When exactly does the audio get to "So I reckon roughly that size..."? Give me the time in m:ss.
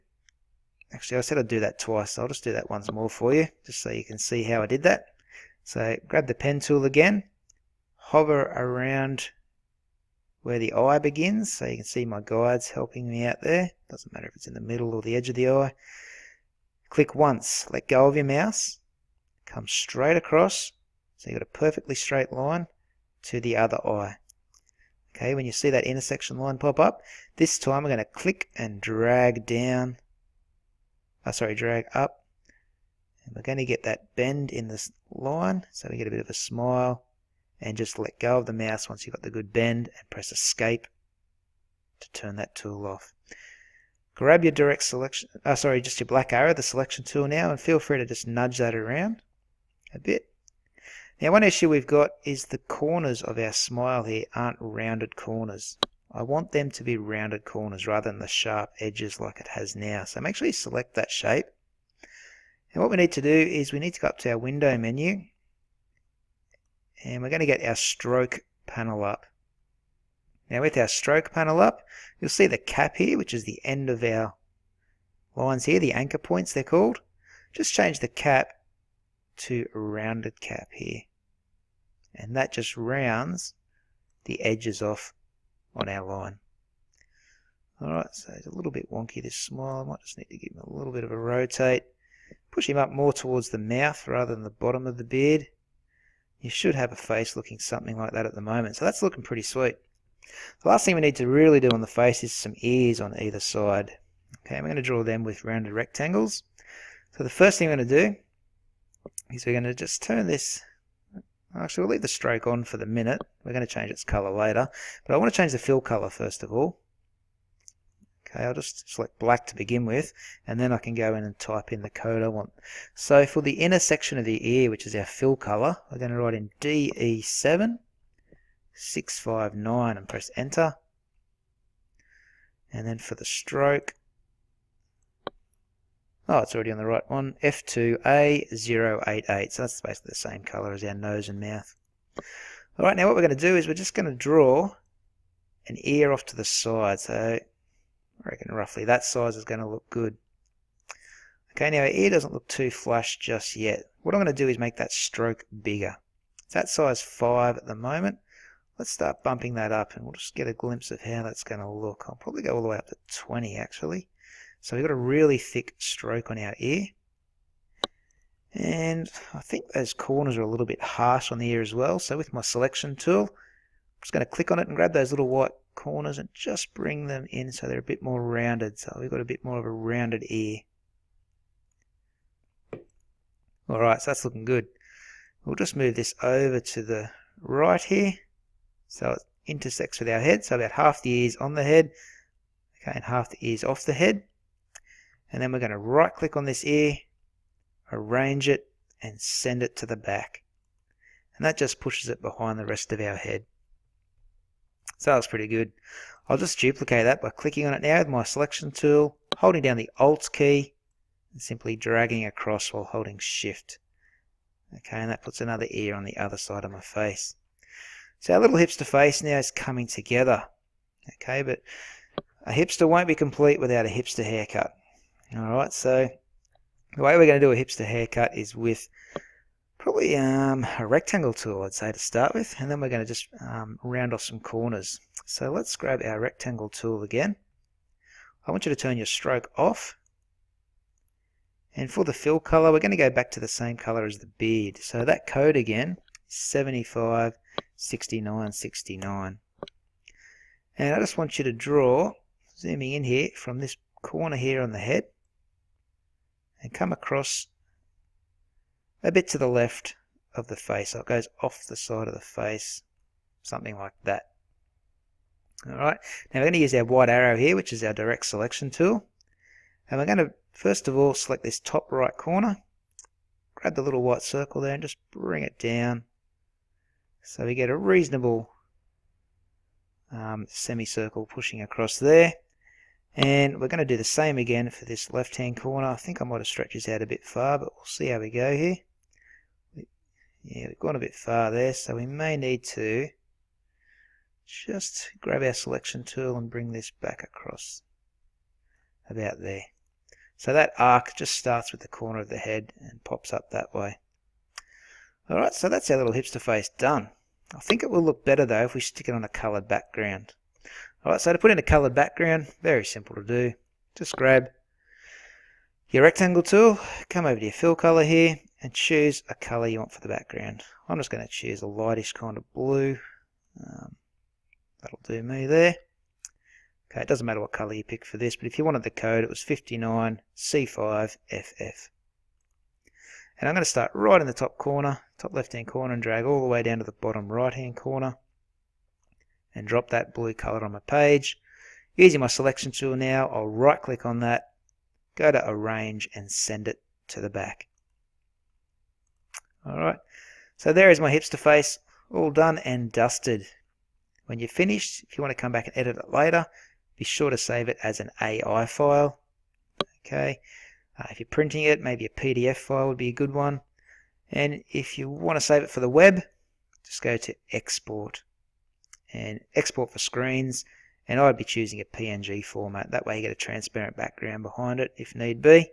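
2:27.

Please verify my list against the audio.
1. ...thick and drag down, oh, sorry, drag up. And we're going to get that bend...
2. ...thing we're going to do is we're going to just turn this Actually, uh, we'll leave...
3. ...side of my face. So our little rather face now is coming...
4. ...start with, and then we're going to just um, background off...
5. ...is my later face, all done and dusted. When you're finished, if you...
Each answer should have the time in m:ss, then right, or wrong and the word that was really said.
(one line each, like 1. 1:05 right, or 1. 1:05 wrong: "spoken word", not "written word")
1. 0:28 wrong: "click", not "thick"
2. 1:47 right
3. 3:36 wrong: "hipster", not "rather"
4. 3:51 wrong: "round", not "background"
5. 5:50 wrong: "hipster", not "later".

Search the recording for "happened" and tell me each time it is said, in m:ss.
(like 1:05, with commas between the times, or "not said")
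not said.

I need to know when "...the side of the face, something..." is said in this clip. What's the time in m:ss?
4:21.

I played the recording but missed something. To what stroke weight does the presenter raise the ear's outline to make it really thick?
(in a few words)
20.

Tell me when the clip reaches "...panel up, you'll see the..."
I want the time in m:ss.
1:11.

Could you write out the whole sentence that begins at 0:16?
Click once, let go of your mouse, come straight across, so you've got a perfectly straight line to the other eye.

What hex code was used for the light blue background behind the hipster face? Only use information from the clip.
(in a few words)
59C5FF.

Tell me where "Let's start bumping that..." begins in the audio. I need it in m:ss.
2:38.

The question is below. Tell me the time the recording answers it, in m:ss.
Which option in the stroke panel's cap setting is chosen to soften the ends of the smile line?
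1:19.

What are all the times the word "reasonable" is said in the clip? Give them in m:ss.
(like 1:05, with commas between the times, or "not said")
4:37.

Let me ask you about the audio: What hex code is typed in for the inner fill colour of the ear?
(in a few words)
DE7659.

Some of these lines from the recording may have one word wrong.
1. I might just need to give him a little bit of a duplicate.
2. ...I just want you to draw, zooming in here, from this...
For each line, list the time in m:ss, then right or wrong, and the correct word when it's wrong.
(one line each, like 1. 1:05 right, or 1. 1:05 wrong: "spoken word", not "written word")
1. 1:29 wrong: "rotate", not "duplicate"
2. 4:10 right.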